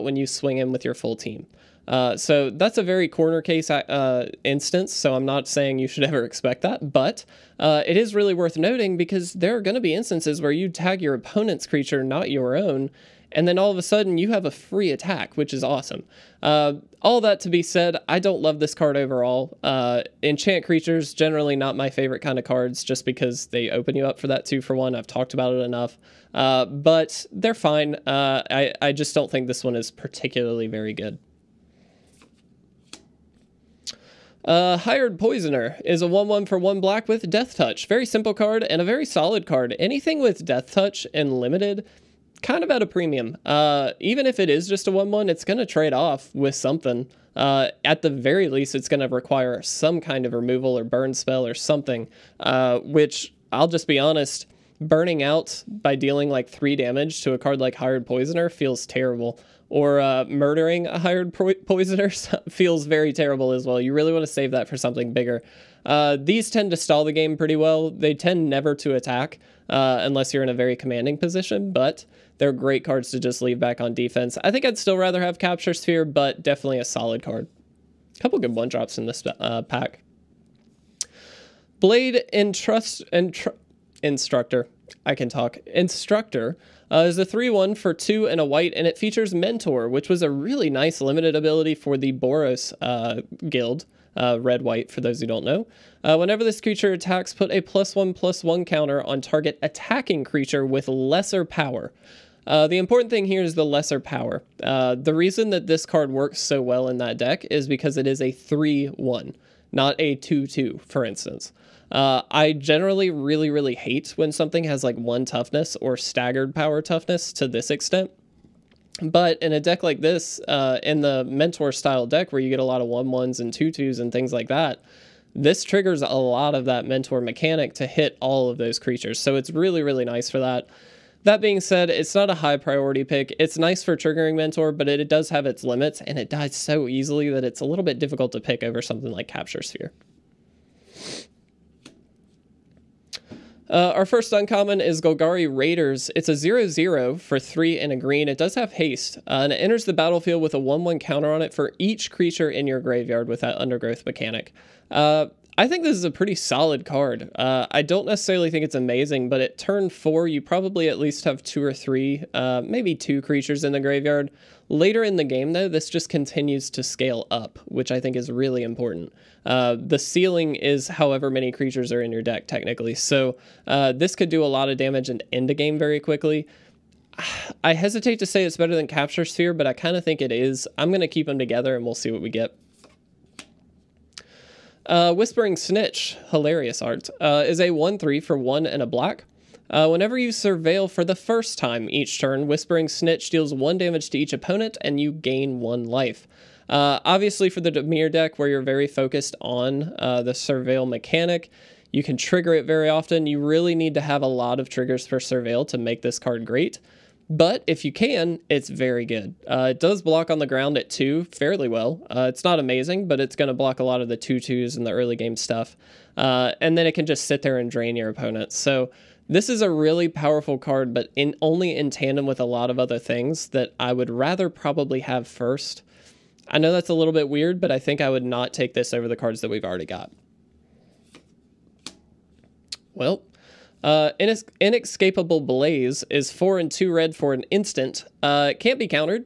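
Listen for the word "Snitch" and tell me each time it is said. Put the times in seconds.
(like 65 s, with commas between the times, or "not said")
185 s, 192 s.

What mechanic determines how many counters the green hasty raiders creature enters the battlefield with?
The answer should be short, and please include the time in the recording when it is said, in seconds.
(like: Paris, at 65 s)
undergrowth, at 153 s.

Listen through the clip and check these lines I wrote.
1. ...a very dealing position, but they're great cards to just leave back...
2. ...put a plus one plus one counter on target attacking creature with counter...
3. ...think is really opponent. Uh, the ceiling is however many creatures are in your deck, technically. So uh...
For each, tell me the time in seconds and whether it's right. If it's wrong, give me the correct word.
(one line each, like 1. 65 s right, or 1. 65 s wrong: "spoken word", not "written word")
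1. 70 s wrong: "commanding", not "dealing"
2. 97 s wrong: "lesser", not "counter"
3. 167 s wrong: "important", not "opponent".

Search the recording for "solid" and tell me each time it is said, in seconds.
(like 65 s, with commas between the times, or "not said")
39 s, 76 s, 156 s.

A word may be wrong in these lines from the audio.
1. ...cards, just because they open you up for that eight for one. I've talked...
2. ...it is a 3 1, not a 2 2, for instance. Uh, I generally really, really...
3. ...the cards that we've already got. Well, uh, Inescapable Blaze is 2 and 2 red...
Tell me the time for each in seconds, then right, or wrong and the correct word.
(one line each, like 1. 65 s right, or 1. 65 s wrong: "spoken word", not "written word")
1. 22 s wrong: "two", not "eight"
2. 107 s right
3. 229 s wrong: "4", not "2".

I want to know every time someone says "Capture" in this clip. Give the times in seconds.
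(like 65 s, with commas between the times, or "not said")
75 s, 139 s, 178 s.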